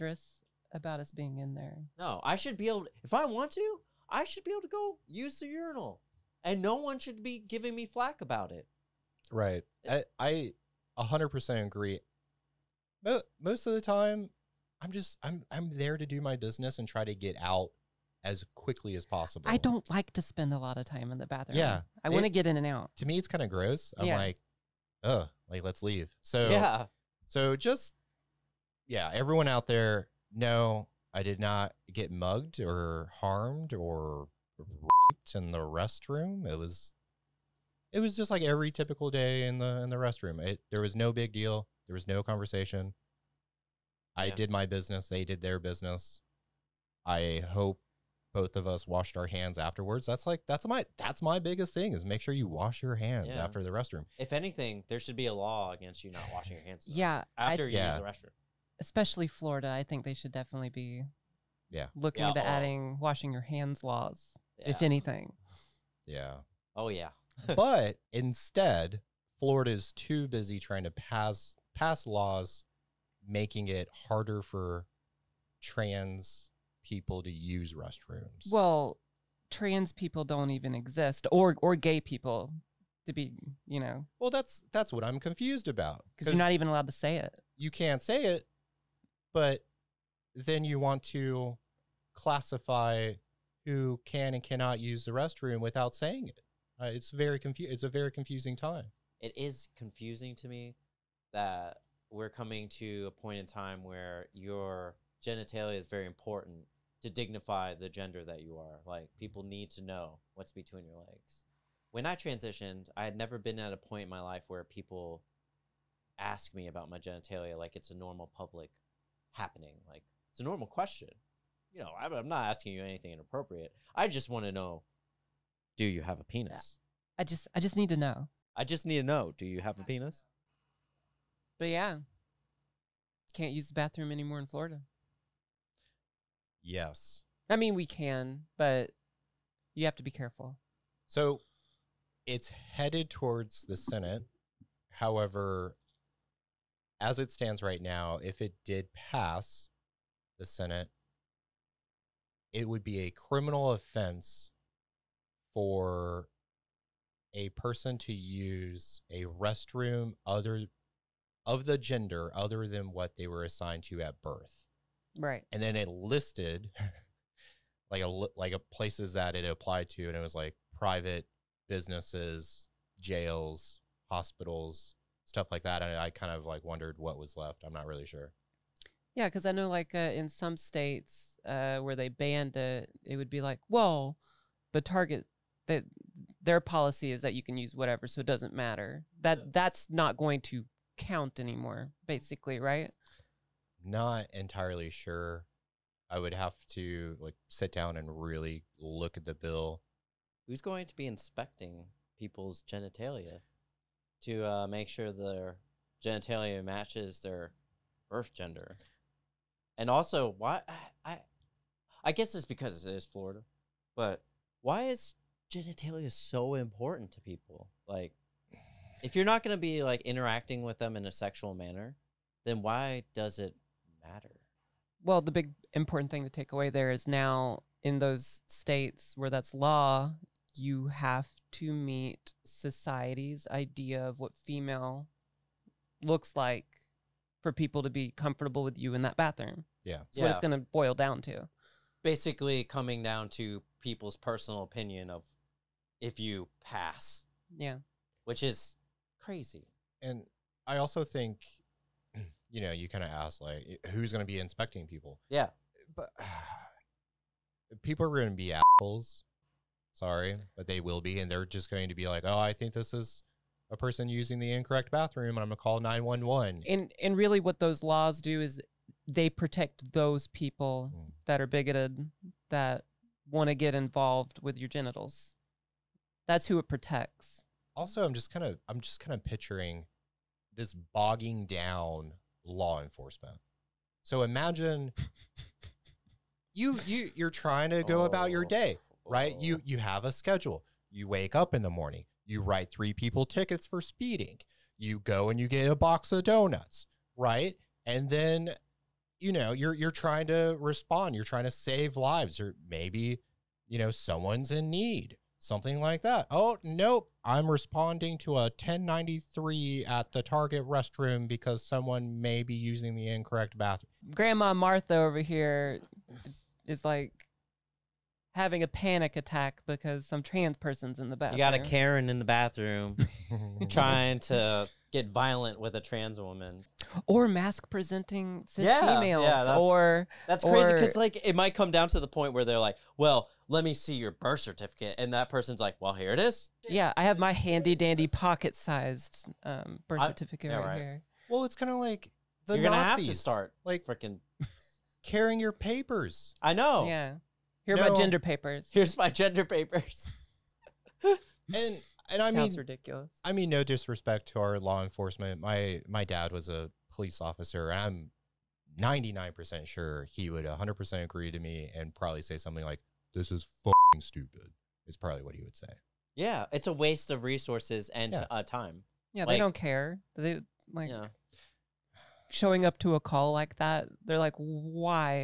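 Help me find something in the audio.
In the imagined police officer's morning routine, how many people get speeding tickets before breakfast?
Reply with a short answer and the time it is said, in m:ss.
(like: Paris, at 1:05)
3, at 4:52.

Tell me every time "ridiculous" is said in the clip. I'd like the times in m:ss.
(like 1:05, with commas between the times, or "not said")
5:52.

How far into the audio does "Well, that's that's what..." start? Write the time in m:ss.
1:24.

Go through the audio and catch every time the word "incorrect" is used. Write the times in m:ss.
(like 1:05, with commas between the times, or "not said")
4:24, 5:13.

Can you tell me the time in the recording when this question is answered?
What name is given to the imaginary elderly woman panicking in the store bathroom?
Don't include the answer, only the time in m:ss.
5:14.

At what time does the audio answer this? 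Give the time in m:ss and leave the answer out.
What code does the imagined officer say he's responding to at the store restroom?
5:08.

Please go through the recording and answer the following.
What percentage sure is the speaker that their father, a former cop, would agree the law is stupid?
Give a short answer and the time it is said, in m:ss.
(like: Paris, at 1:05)
99%, at 5:58.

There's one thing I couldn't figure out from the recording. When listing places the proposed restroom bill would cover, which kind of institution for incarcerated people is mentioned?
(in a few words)
jails.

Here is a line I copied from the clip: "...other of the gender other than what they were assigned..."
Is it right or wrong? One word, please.
right.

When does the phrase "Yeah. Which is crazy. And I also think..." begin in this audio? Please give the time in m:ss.
4:07.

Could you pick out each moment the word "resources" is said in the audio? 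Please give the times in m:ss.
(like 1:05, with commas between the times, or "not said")
6:07.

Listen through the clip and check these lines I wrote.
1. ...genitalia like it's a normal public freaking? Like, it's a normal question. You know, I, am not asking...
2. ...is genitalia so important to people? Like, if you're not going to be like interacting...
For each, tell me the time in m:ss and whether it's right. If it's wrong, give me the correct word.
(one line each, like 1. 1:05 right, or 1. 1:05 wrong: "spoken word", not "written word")
1. 1:56 wrong: "happening", not "freaking"
2. 3:34 right.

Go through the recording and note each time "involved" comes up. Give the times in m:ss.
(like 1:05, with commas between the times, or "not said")
4:33.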